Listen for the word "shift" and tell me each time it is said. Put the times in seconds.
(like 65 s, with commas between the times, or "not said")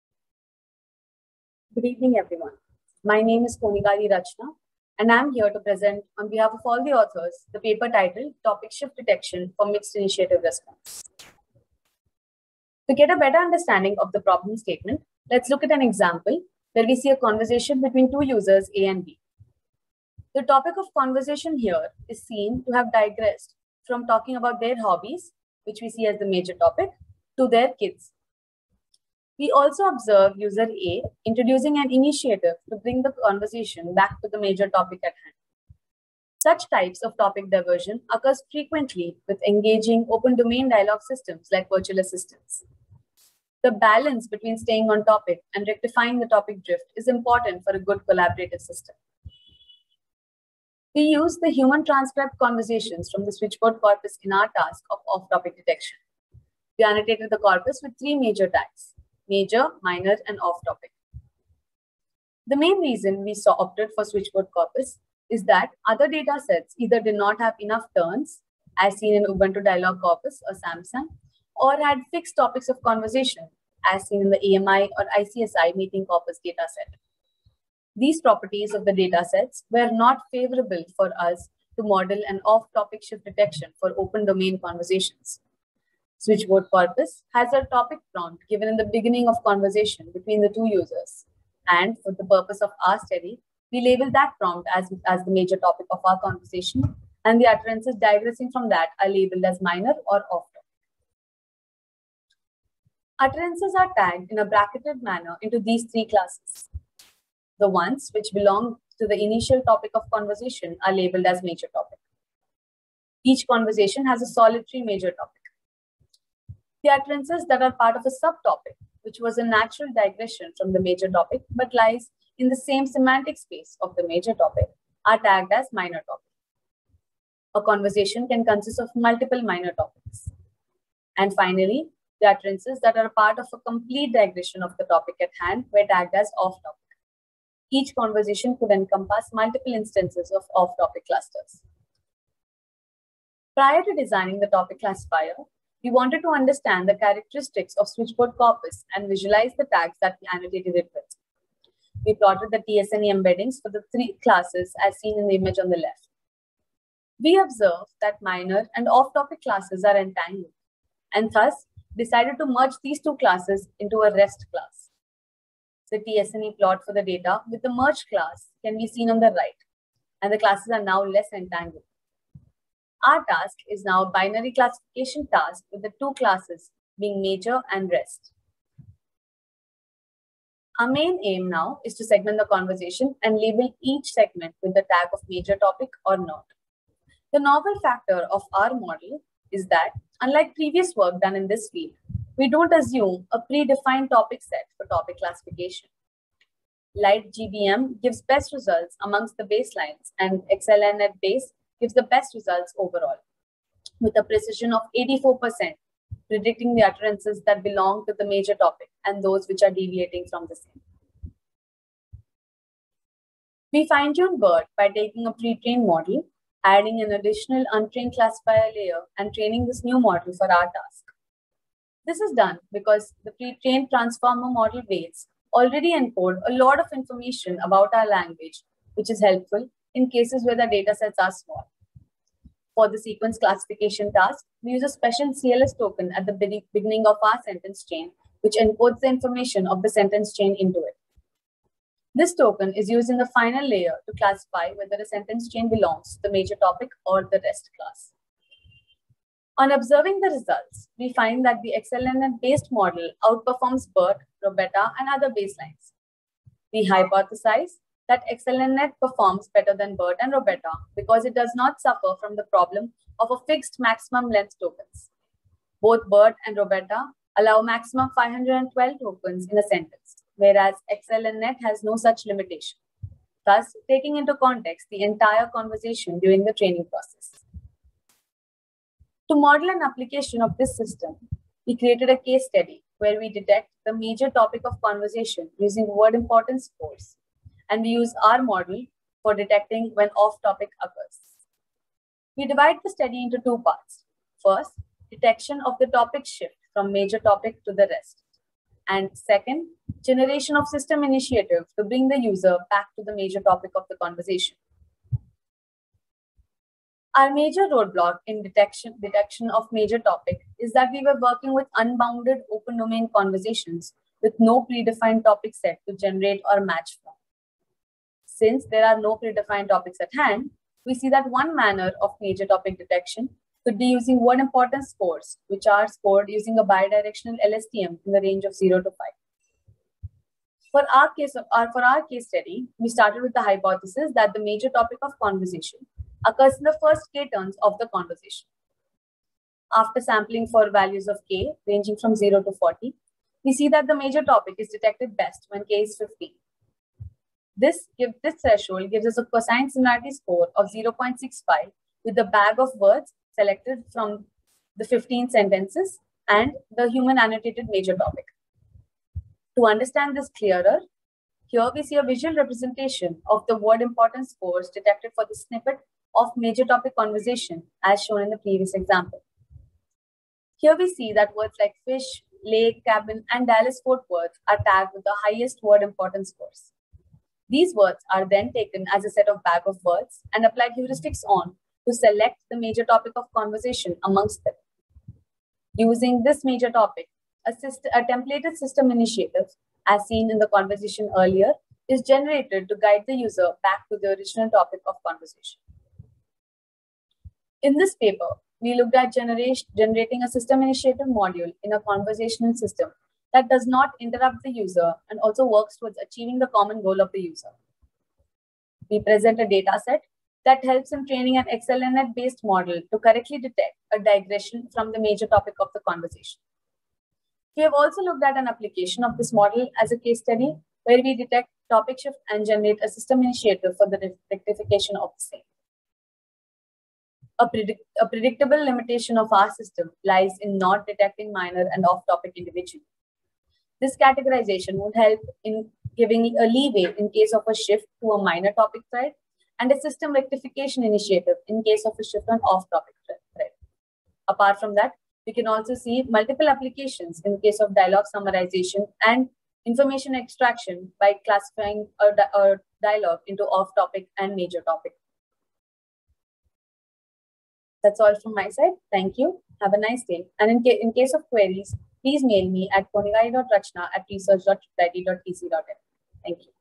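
8 s, 83 s, 296 s, 422 s, 437 s, 442 s.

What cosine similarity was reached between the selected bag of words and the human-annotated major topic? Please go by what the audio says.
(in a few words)
0.65.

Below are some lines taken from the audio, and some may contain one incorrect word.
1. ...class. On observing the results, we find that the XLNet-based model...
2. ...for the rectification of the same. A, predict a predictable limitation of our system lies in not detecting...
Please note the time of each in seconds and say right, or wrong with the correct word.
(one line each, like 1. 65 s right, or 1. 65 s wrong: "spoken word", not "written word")
1. 247 s right
2. 423 s right.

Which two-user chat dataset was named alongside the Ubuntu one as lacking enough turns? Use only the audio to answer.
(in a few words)
SAMSum.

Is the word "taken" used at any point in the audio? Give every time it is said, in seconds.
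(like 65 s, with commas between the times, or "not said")
378 s.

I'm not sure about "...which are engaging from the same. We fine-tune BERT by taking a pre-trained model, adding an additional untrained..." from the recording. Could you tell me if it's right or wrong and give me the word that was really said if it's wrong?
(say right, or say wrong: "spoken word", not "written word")
wrong: "deviating", not "engaging".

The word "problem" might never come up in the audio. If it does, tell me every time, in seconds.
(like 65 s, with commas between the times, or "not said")
14 s, 262 s.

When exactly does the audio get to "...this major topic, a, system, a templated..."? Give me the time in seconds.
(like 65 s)
386 s.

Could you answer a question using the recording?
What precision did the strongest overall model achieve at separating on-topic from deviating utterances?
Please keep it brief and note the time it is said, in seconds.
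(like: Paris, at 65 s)
84%, at 204 s.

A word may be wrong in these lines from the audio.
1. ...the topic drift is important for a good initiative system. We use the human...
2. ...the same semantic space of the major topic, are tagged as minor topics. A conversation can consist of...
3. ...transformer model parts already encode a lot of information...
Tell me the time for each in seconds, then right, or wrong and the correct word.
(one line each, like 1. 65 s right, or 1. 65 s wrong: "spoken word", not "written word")
1. 46 s wrong: "collaborative", not "initiative"
2. 122 s right
3. 223 s wrong: "weights", not "parts".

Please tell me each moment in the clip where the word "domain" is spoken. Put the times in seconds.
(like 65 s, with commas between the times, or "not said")
40 s, 84 s, 312 s.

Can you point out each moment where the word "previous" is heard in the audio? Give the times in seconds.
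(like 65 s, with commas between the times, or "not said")
190 s, 368 s.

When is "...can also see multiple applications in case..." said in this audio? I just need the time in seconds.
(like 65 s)
445 s.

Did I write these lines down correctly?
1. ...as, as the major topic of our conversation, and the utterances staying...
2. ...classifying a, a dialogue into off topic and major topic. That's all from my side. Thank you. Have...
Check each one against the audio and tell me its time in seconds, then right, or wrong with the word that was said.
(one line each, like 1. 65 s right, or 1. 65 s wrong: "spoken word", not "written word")
1. 94 s wrong: "digressing", not "staying"
2. 451 s right.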